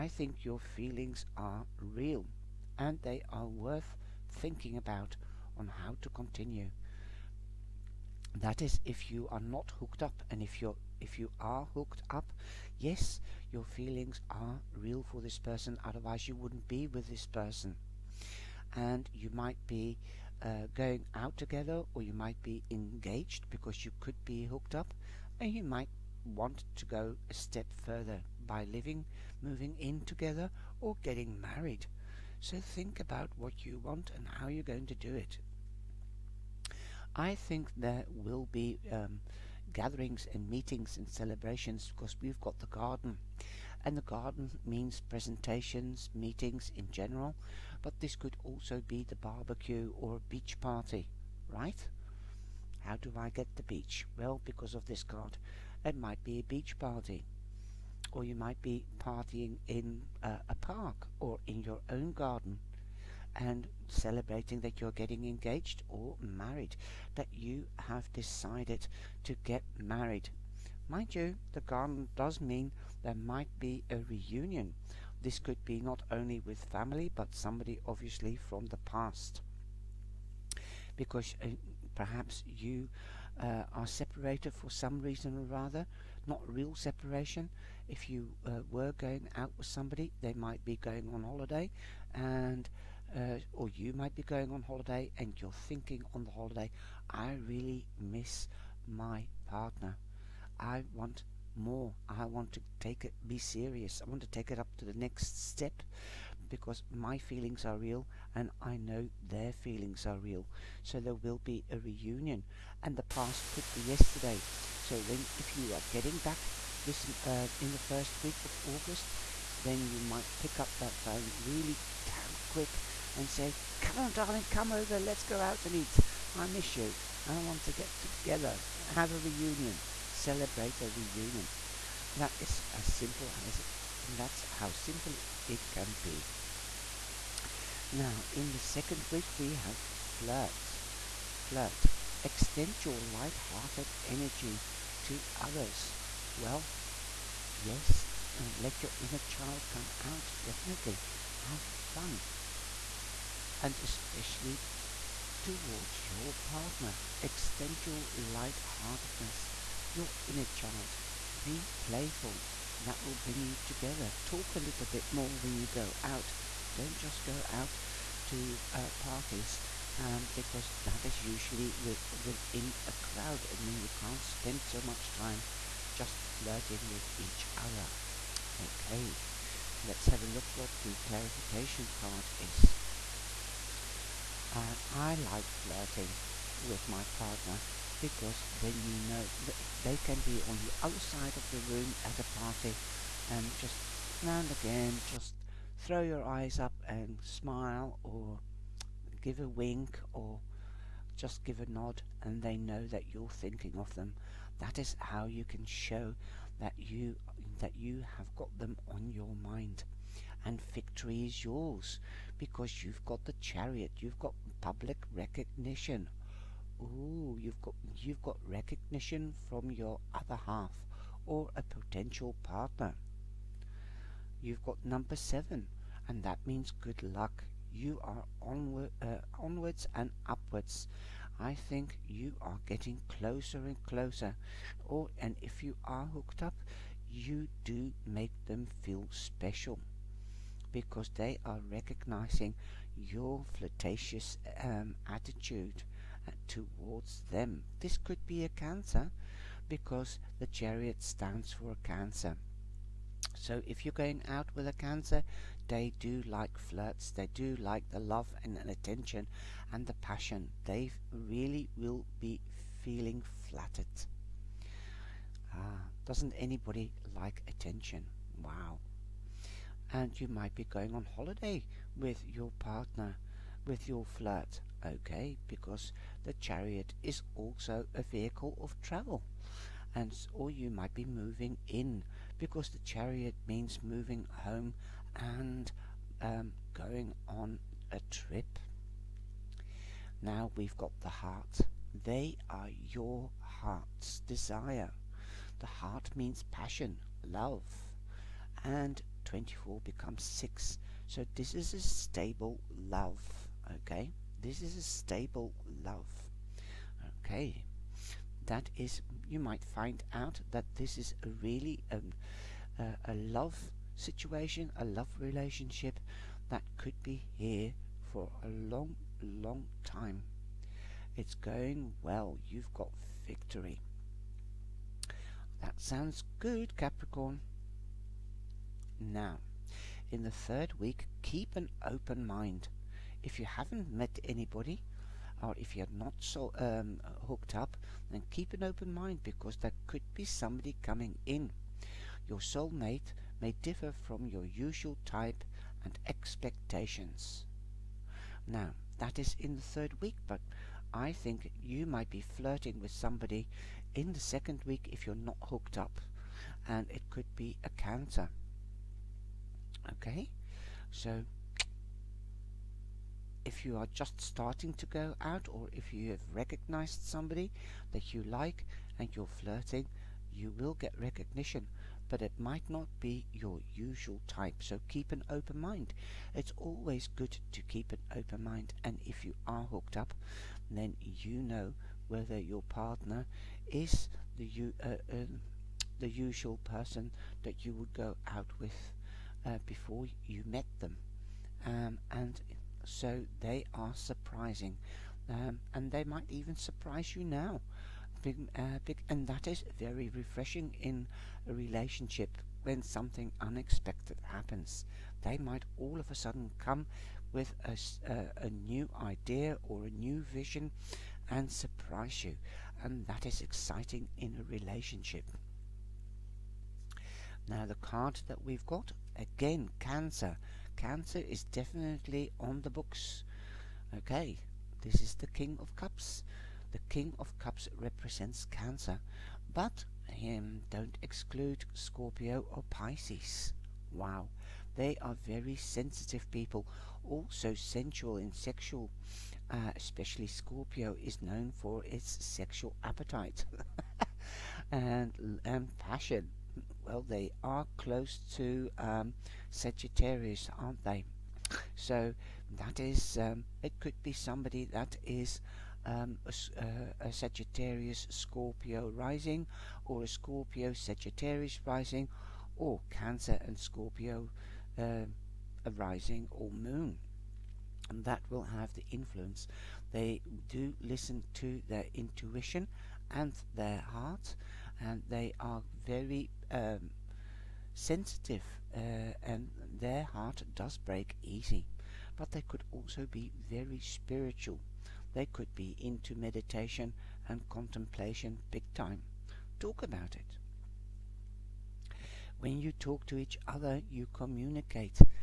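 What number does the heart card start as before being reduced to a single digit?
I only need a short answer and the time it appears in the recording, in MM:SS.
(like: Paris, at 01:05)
24, at 04:59.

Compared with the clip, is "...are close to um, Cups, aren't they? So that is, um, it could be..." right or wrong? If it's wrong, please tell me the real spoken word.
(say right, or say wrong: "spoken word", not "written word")
wrong: "Sagittarius", not "Cups".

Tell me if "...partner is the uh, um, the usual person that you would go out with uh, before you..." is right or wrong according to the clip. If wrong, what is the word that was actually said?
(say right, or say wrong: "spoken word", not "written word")
right.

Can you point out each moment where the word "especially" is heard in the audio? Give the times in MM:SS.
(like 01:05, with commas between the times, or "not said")
02:33, 07:19.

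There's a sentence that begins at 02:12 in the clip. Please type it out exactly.
That is as simple as it, and that's how simple it, it can be.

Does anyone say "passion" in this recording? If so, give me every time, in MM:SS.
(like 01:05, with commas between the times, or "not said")
04:19, 04:56, 07:25.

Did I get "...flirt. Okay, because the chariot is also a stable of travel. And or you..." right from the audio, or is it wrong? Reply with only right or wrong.
wrong.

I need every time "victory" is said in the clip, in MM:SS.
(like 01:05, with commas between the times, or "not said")
03:30, 05:23.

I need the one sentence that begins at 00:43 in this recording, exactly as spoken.
And the garden means presentations, meetings in general, but this could also be the barbecue or a beach party, right?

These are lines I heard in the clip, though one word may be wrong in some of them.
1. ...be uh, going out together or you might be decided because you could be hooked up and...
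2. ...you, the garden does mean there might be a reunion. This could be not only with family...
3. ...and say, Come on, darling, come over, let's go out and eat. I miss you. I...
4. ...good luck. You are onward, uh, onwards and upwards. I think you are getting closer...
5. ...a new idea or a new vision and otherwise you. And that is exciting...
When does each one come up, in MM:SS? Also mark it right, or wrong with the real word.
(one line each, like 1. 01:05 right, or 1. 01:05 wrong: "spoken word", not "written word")
1. 00:19 wrong: "engaged", not "decided"
2. 01:11 right
3. 02:03 right
4. 03:46 right
5. 06:48 wrong: "surprise", not "otherwise".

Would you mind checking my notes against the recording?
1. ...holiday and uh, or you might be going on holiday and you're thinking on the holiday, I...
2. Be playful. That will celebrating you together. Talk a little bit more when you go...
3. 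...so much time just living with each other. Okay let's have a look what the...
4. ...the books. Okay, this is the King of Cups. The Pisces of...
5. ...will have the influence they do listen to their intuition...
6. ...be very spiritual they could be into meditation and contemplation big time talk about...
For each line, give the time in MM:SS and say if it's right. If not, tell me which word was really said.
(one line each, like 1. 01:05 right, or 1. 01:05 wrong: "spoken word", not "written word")
1. 01:31 right
2. 02:41 wrong: "bring", not "celebrating"
3. 02:54 wrong: "flirting", not "living"
4. 07:02 wrong: "King", not "Pisces"
5. 07:48 right
6. 08:03 right.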